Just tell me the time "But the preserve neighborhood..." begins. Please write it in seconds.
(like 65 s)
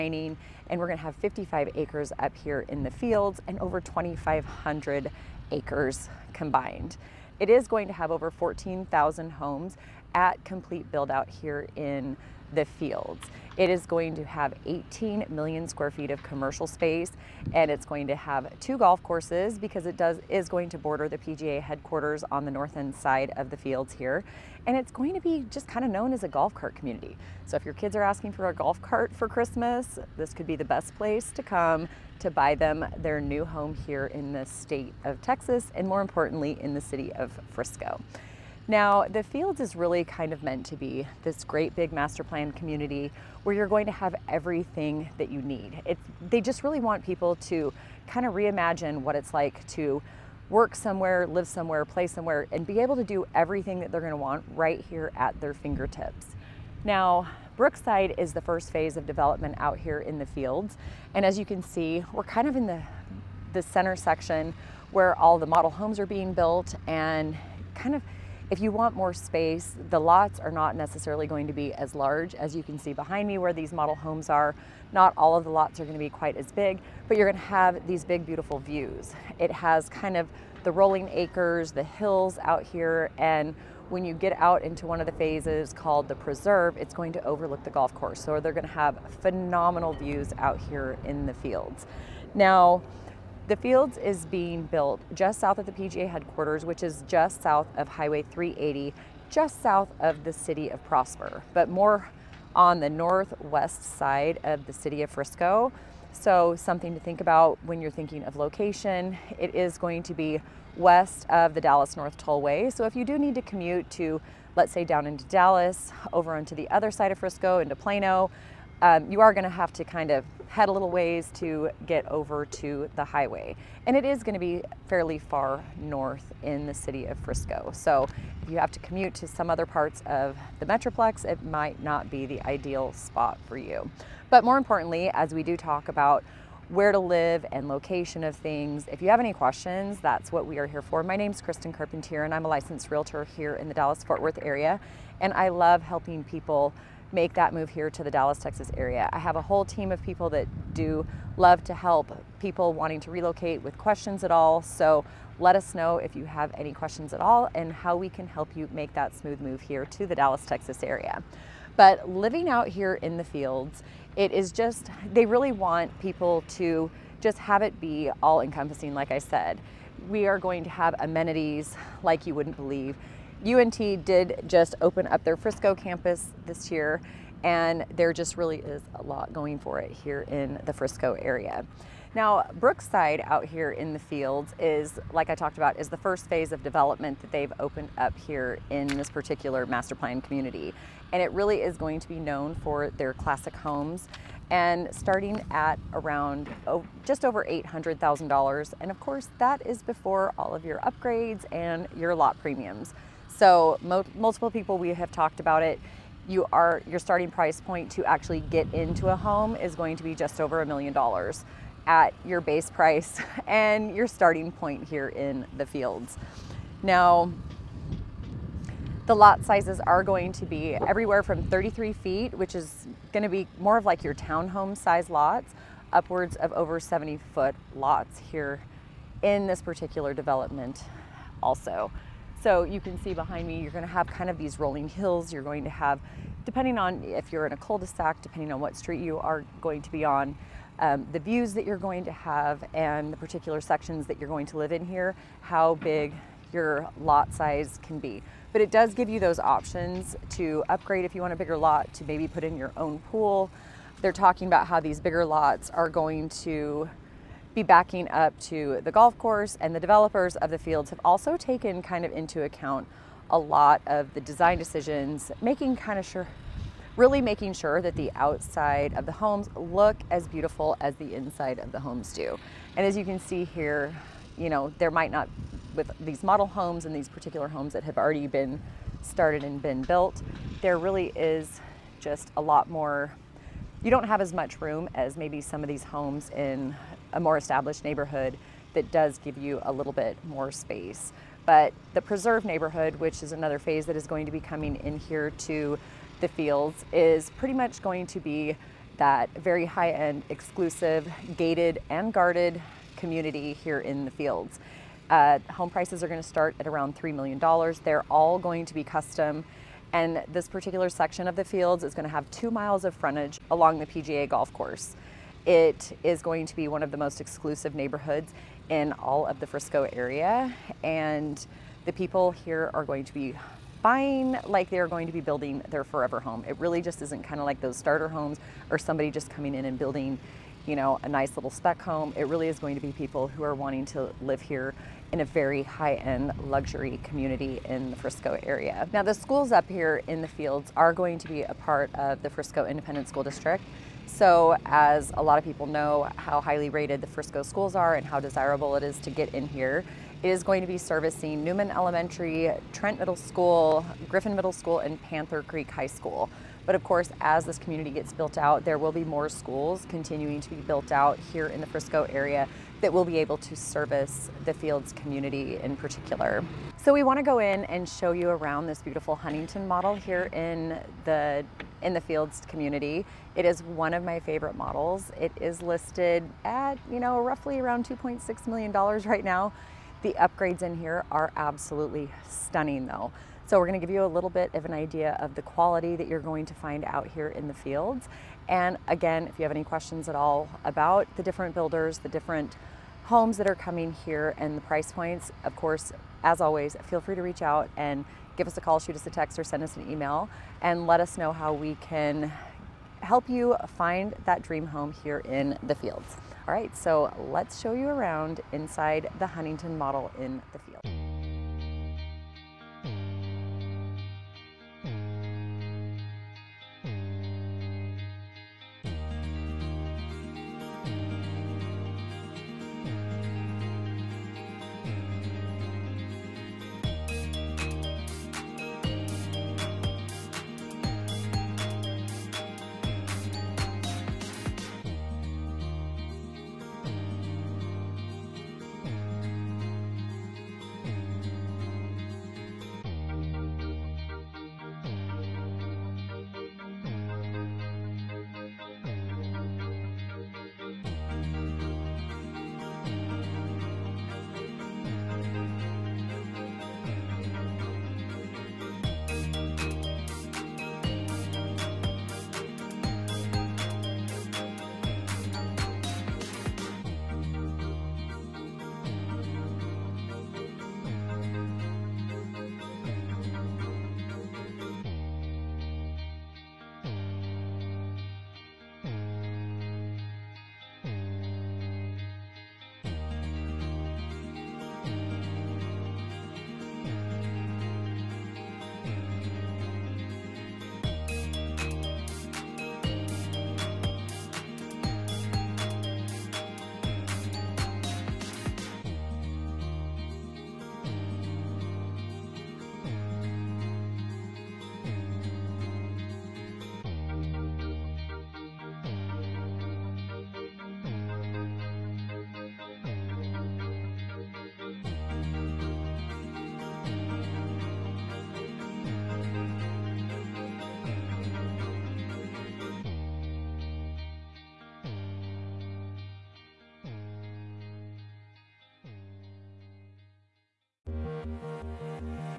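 291 s.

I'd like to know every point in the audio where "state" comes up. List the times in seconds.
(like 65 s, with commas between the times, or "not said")
34 s.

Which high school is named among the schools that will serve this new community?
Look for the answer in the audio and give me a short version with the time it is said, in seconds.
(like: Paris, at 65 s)
Panther Creek High School, at 355 s.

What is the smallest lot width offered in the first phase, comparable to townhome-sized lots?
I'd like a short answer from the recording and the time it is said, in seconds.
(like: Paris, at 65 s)
33 feet, at 221 s.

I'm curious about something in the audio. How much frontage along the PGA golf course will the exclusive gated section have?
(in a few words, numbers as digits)
two miles.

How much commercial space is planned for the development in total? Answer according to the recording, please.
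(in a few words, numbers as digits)
18 million square feet.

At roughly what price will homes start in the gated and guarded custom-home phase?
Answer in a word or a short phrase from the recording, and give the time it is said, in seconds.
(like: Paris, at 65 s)
$3 million, at 306 s.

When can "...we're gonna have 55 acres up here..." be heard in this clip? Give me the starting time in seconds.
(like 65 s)
0 s.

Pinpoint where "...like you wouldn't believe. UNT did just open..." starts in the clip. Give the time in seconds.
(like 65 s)
172 s.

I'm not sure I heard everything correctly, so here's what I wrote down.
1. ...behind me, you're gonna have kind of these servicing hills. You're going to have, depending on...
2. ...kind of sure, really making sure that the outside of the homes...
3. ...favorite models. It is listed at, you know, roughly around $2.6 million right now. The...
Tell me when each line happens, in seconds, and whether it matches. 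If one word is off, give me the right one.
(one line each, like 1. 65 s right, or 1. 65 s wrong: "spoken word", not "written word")
1. 233 s wrong: "rolling", not "servicing"
2. 265 s right
3. 374 s right.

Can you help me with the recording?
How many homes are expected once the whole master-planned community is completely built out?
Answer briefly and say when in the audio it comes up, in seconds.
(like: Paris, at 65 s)
over 14,000, at 8 s.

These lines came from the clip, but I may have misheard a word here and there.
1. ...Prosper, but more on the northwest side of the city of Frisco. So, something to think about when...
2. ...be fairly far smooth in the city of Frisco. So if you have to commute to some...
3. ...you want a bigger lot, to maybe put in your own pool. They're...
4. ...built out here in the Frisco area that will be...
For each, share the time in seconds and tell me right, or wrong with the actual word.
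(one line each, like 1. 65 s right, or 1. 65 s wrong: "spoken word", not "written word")
1. 100 s right
2. 124 s wrong: "north", not "smooth"
3. 251 s right
4. 360 s right.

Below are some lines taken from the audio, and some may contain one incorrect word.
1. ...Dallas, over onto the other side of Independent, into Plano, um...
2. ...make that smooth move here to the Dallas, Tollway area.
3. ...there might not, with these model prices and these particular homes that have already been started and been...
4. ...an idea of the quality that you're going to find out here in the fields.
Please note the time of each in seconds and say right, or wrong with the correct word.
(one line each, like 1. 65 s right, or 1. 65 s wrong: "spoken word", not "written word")
1. 115 s wrong: "Frisco", not "Independent"
2. 158 s wrong: "Texas", not "Tollway"
3. 274 s wrong: "homes", not "prices"
4. 384 s right.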